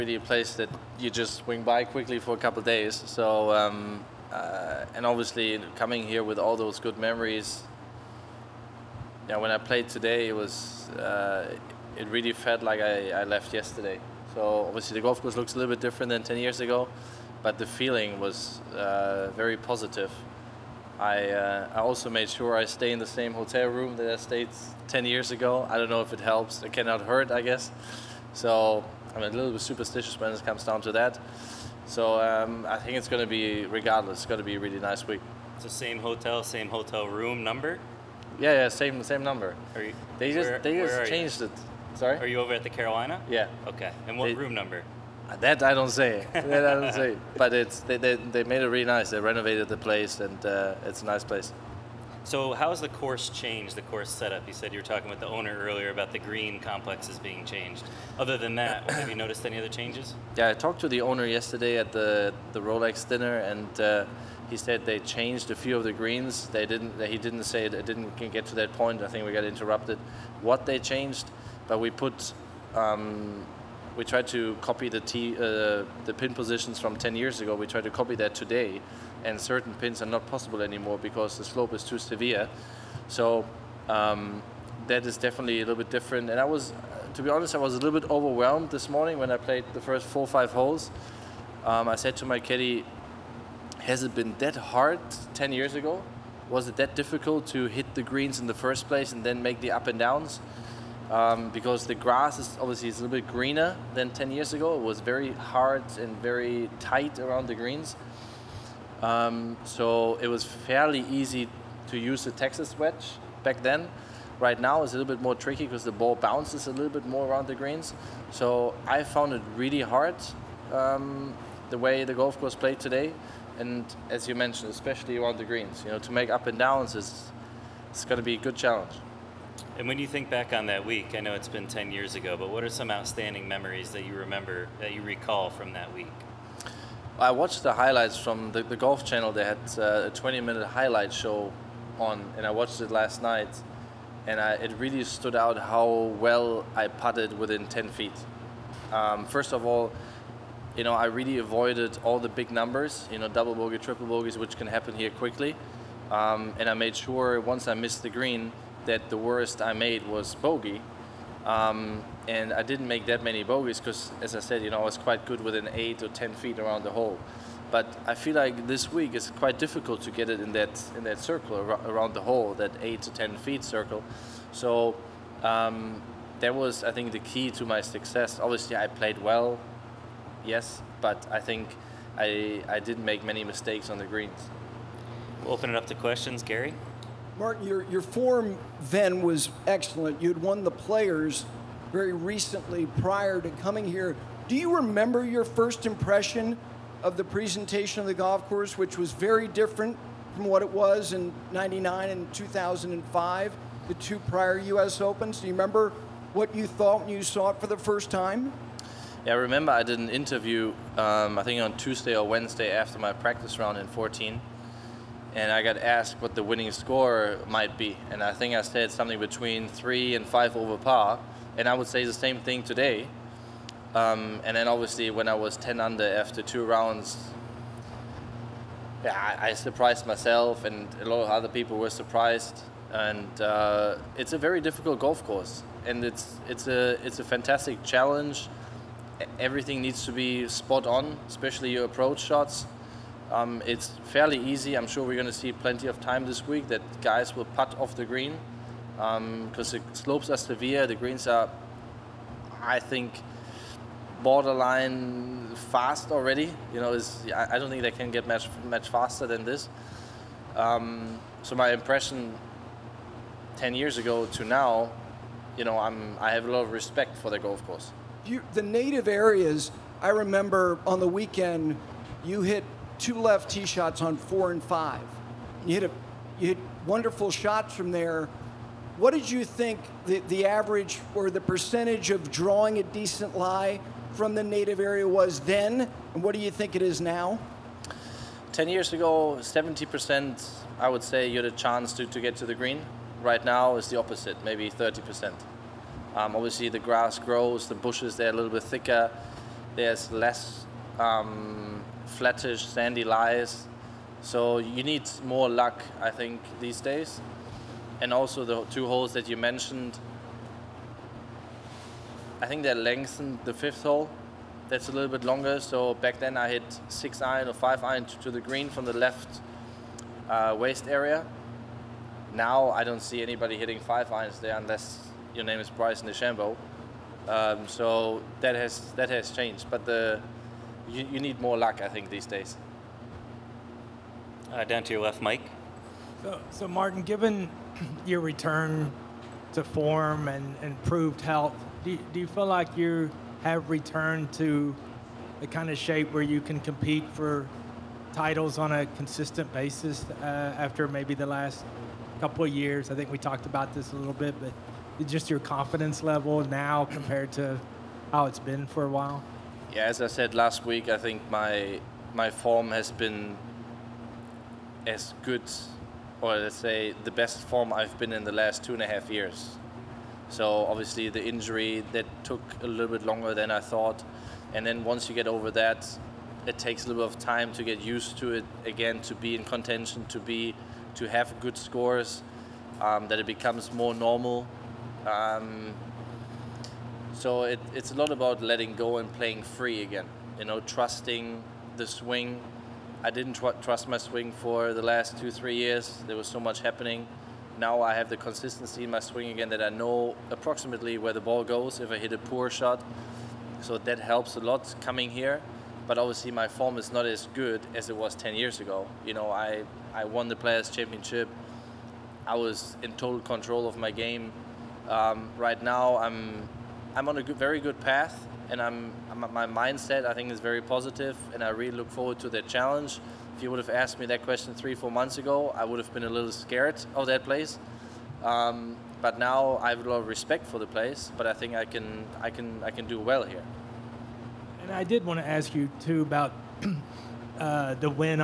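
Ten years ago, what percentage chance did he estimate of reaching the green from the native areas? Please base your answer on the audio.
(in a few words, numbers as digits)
70%.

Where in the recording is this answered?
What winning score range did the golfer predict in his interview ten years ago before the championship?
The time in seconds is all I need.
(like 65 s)
219 s.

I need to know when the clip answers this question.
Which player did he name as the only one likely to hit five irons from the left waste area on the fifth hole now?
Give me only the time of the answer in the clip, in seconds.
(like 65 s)
325 s.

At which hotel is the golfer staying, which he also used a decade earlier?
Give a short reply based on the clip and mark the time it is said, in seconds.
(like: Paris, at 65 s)
The Carolina, at 42 s.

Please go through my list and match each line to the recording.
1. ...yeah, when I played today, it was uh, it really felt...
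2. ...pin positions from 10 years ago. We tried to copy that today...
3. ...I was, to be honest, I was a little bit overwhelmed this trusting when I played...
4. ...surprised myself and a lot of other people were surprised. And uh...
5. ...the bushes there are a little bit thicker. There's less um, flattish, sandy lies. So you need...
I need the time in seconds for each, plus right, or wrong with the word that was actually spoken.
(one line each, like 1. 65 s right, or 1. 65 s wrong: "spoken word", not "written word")
1. 9 s right
2. 76 s right
3. 86 s wrong: "morning", not "trusting"
4. 229 s right
5. 297 s right.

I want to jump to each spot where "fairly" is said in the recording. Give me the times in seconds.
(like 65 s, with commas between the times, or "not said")
110 s, 244 s.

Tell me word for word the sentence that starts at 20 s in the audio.
I uh, I also made sure I stay in the same hotel room that I stayed 10 years ago.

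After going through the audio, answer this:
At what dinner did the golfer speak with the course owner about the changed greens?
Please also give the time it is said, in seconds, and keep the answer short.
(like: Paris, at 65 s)
Rolex dinner, at 62 s.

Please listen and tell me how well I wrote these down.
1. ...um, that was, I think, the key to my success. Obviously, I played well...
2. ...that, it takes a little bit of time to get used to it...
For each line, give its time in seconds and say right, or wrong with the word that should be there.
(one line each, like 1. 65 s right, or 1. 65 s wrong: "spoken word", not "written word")
1. 175 s right
2. 375 s right.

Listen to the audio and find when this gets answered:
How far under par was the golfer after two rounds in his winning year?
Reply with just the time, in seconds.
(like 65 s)
225 s.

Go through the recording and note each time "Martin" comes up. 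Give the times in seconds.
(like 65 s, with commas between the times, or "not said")
187 s, 336 s.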